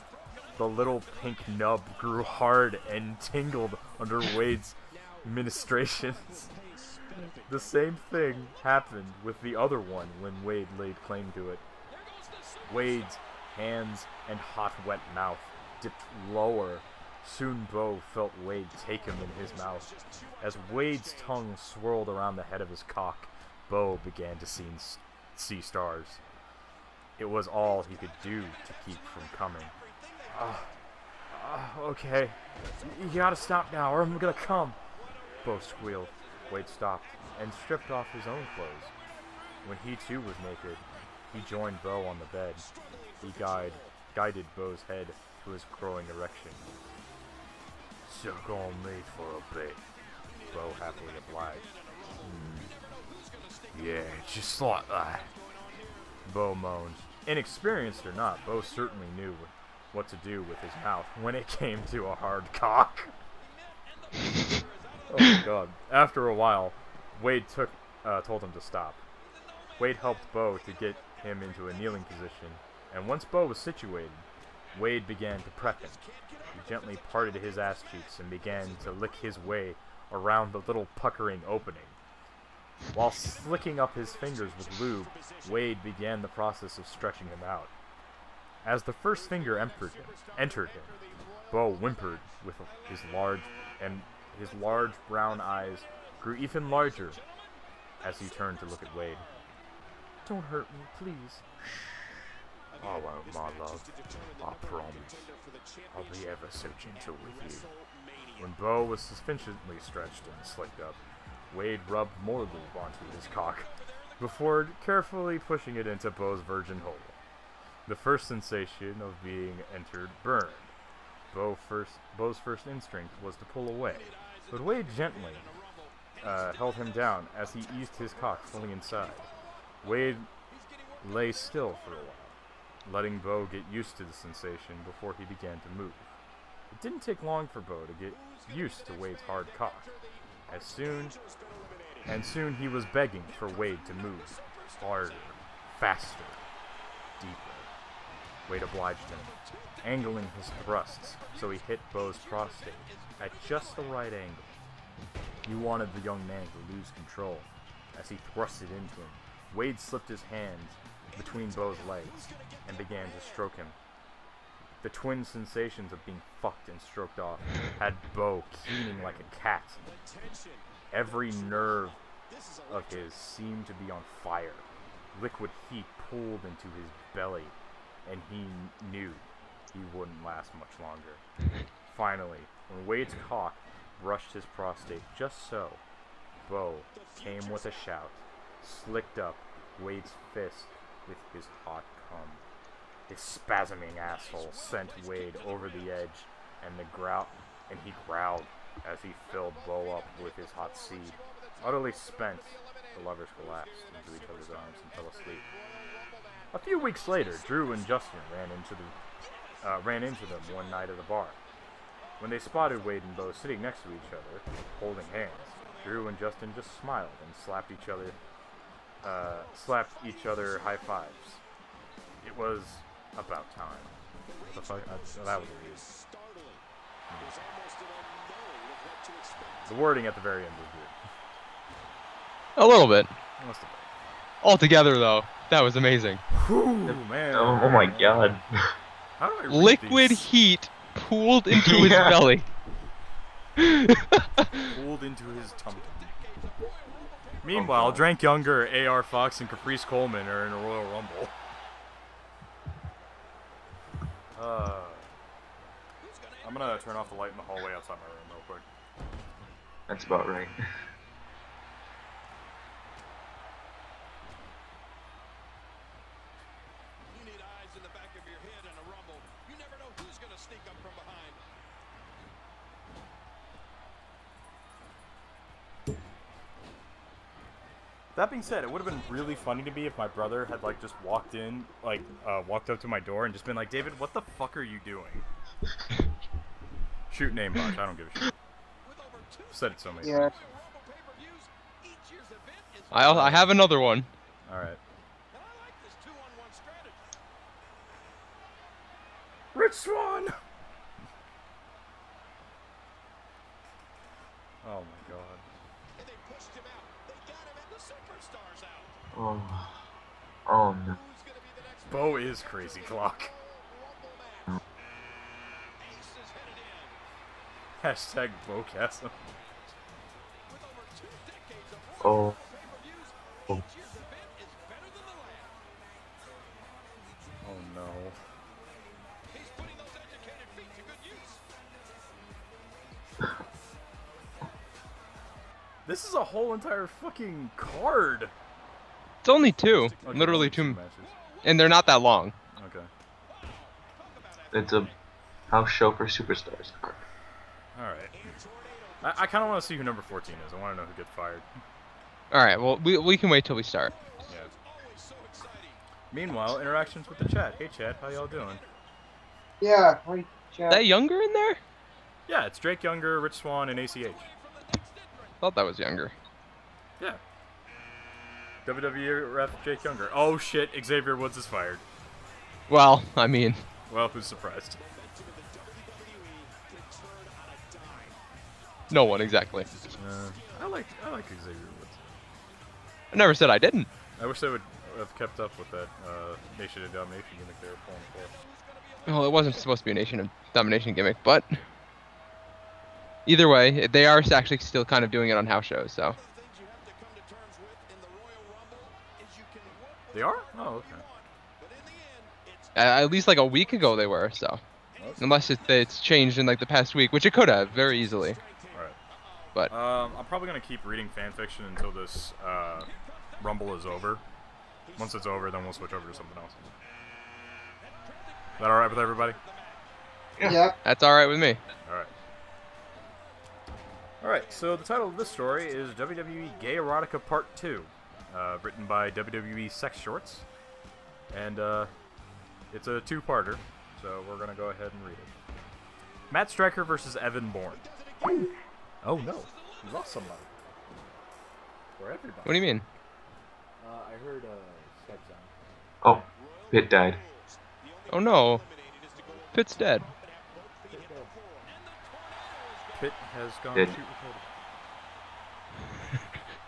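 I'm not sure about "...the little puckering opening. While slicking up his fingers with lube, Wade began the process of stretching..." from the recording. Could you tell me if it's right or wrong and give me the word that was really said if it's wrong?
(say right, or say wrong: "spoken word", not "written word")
right.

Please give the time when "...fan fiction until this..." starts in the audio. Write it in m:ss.
6:51.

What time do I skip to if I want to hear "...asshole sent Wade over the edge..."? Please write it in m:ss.
3:13.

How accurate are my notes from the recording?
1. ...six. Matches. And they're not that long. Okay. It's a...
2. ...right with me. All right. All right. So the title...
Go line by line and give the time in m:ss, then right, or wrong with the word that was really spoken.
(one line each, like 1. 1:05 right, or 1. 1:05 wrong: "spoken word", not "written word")
1. 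5:40 wrong: "two", not "six"
2. 7:01 right.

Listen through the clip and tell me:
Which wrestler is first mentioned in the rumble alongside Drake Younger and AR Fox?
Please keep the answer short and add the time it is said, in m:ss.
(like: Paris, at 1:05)
Caprice Coleman, at 4:09.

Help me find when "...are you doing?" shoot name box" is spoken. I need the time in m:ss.
4:44.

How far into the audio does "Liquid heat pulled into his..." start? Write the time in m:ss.
2:55.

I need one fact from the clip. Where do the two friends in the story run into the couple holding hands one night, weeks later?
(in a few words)
a bar.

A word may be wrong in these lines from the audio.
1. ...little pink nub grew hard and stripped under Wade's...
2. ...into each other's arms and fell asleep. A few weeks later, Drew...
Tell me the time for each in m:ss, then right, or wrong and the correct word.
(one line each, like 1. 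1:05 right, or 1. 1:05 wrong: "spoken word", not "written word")
1. 0:00 wrong: "tingled", not "stripped"
2. 3:23 right.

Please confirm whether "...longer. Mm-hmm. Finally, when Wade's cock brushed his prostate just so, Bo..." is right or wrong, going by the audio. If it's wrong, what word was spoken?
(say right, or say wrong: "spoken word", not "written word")
right.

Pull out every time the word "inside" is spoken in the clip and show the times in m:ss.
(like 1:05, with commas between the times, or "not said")
2:08.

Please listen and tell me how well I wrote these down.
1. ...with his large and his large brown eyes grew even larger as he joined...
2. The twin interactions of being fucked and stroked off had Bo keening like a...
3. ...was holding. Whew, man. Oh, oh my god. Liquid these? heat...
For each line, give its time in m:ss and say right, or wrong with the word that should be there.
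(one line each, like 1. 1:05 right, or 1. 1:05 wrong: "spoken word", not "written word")
1. 1:32 wrong: "turned", not "joined"
2. 2:44 wrong: "sensations", not "interactions"
3. 3:55 wrong: "amazing", not "holding".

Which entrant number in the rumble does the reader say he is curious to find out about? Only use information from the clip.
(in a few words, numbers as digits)
14.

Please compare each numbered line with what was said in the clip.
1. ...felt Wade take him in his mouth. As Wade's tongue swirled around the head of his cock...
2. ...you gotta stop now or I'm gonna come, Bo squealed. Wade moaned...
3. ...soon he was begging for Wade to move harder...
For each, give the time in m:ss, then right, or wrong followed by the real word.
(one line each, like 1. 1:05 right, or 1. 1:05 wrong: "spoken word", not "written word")
1. 0:18 right
2. 0:33 wrong: "stopped", not "moaned"
3. 2:22 right.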